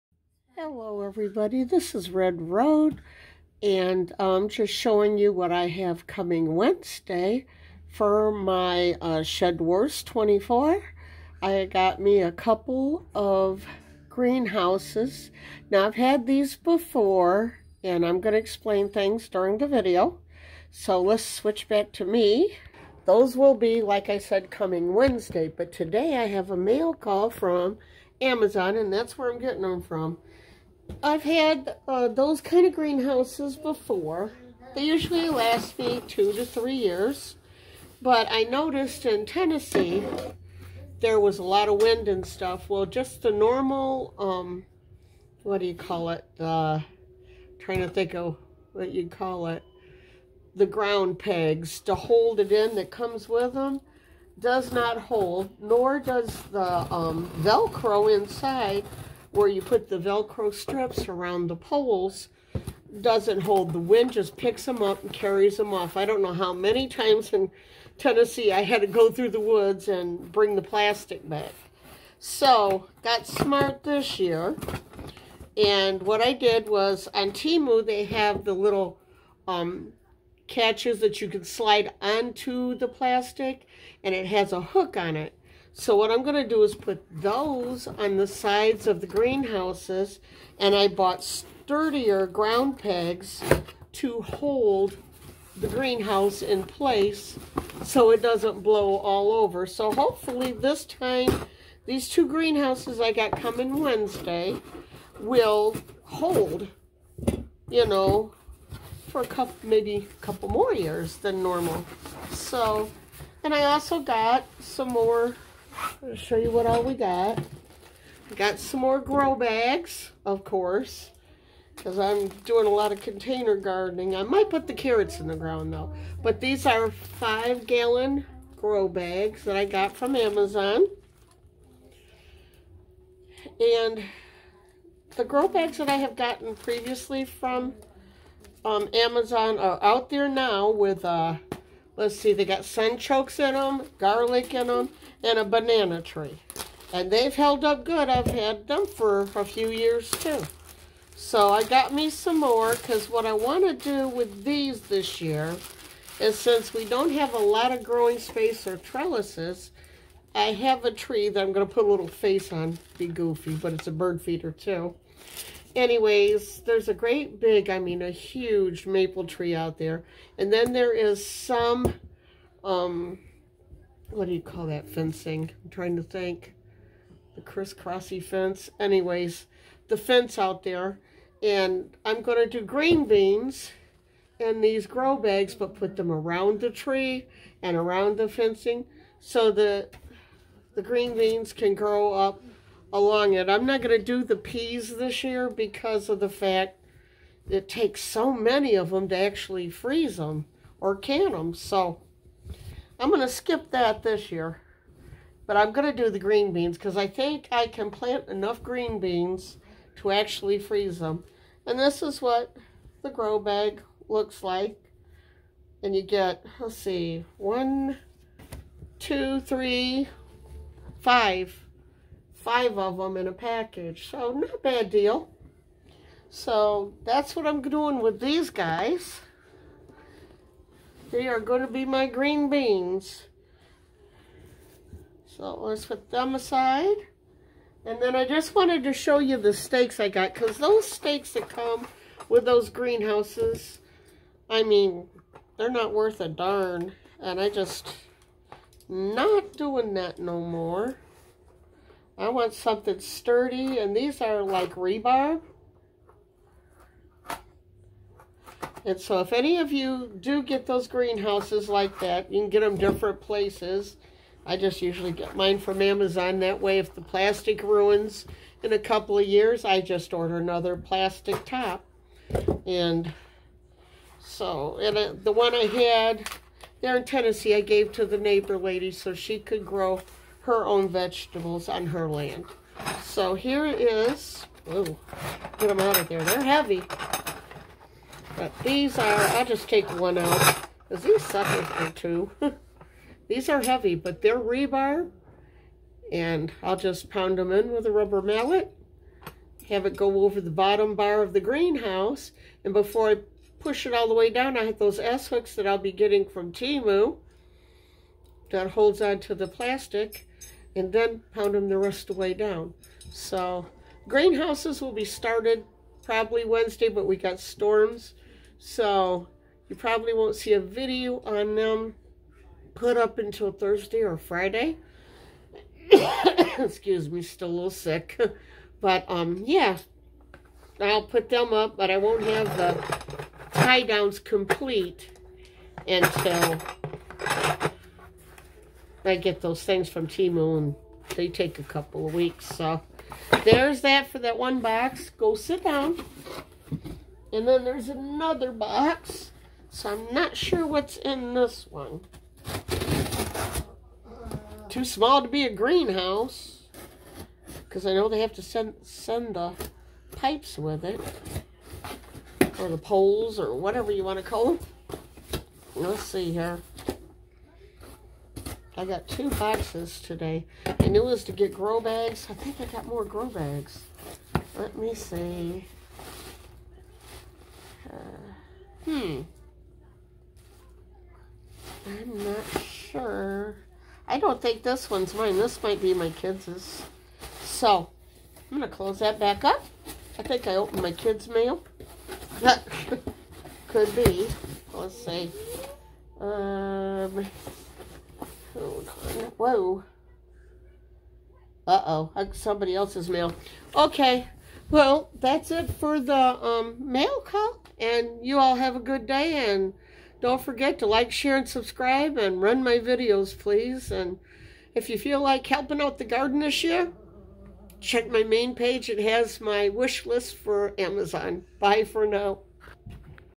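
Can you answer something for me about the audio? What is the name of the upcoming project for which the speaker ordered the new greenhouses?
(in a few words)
Shed Wars 24.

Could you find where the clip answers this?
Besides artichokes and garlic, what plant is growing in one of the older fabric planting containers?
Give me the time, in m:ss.
2:25.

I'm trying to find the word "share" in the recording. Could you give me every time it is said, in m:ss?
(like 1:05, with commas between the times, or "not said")
6:51.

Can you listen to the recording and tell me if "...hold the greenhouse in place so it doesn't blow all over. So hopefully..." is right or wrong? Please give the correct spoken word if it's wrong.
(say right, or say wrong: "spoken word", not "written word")
right.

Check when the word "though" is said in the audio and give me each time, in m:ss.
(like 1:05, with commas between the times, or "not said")
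2:05.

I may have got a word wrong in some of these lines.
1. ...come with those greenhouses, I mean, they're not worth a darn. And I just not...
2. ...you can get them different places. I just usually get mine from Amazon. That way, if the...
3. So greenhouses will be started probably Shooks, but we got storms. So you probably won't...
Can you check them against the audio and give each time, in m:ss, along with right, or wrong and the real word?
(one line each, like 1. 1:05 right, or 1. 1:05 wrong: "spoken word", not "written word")
1. 4:01 right
2. 4:22 right
3. 5:13 wrong: "Wednesday", not "Shooks".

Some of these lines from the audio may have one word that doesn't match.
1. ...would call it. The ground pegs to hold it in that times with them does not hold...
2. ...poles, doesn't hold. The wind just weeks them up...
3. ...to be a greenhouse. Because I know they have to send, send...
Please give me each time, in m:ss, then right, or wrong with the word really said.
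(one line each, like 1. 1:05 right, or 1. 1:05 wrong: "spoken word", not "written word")
1. 0:49 wrong: "comes", not "times"
2. 1:01 wrong: "picks", not "weeks"
3. 5:55 right.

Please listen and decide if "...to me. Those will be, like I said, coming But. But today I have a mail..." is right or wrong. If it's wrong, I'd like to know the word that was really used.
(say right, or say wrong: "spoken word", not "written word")
wrong: "Wednesday", not "But".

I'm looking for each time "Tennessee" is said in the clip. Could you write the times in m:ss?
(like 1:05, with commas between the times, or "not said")
0:39, 1:07, 4:37.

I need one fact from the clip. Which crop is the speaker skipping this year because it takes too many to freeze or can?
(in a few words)
peas.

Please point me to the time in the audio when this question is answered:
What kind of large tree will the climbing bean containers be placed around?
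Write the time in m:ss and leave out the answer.
2:48.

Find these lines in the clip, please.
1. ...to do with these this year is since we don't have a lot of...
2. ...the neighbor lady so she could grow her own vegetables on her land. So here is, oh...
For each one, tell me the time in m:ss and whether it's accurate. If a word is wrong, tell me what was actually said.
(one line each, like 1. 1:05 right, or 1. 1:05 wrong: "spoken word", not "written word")
1. 2:33 right
2. 4:38 right.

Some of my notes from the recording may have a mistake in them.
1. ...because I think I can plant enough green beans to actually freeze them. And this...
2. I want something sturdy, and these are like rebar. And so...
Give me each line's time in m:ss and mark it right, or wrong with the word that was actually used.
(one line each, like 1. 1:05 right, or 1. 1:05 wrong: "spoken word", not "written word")
1. 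3:26 right
2. 4:12 right.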